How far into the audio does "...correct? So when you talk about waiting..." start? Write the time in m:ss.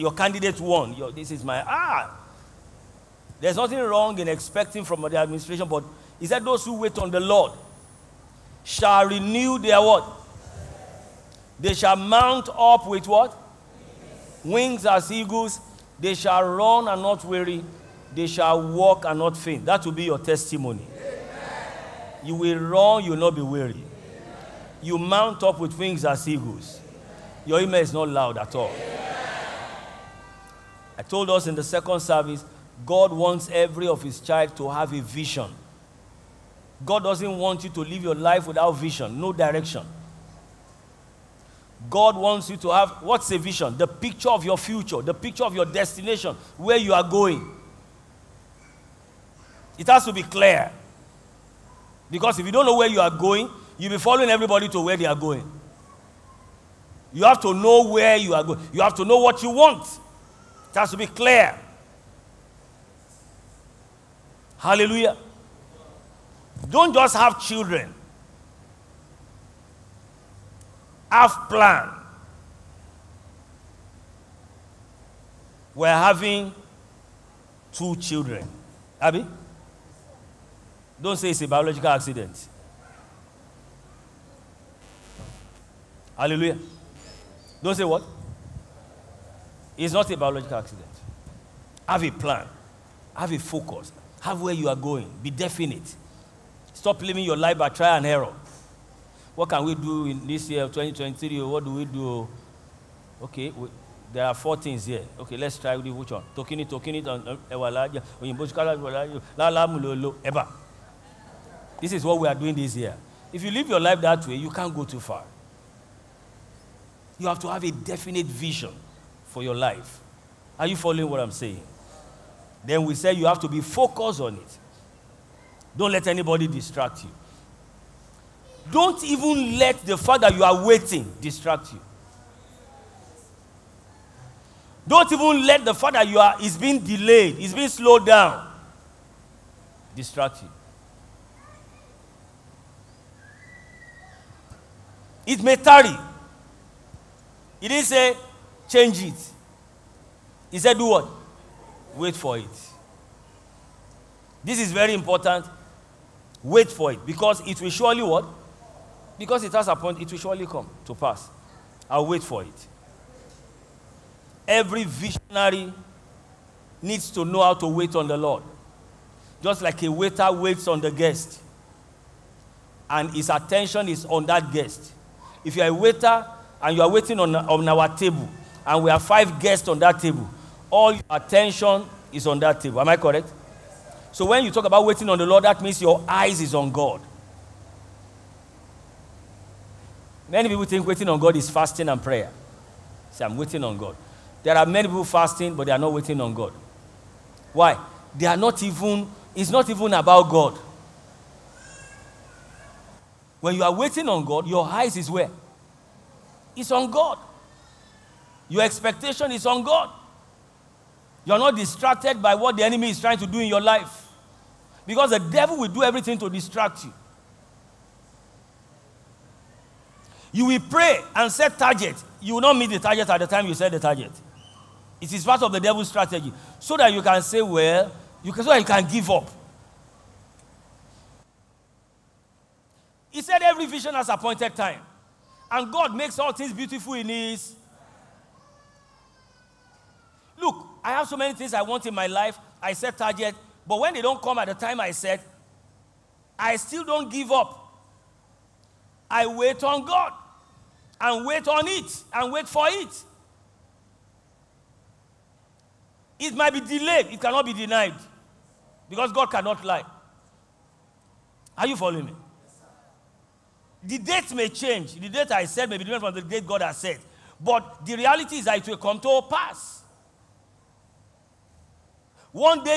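3:02.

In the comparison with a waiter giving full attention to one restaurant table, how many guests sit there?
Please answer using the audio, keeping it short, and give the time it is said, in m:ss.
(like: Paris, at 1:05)
5, at 2:59.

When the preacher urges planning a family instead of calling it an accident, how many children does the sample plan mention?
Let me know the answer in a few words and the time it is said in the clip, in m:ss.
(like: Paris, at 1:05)
2, at 1:17.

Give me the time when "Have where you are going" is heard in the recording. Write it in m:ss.
1:34.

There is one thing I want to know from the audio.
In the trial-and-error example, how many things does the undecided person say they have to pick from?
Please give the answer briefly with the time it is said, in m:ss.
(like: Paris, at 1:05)
4, at 1:44.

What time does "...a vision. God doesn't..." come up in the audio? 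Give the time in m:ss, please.
0:34.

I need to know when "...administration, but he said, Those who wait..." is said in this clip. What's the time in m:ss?
0:05.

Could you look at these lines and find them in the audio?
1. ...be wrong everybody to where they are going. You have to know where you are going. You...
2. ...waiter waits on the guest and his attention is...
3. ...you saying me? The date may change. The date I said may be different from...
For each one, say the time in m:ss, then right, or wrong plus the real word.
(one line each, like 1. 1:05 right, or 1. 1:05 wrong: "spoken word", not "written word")
1. 0:53 wrong: "following", not "wrong"
2. 2:49 right
3. 4:21 wrong: "following", not "saying".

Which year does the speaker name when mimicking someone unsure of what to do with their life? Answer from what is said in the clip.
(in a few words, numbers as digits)
2023.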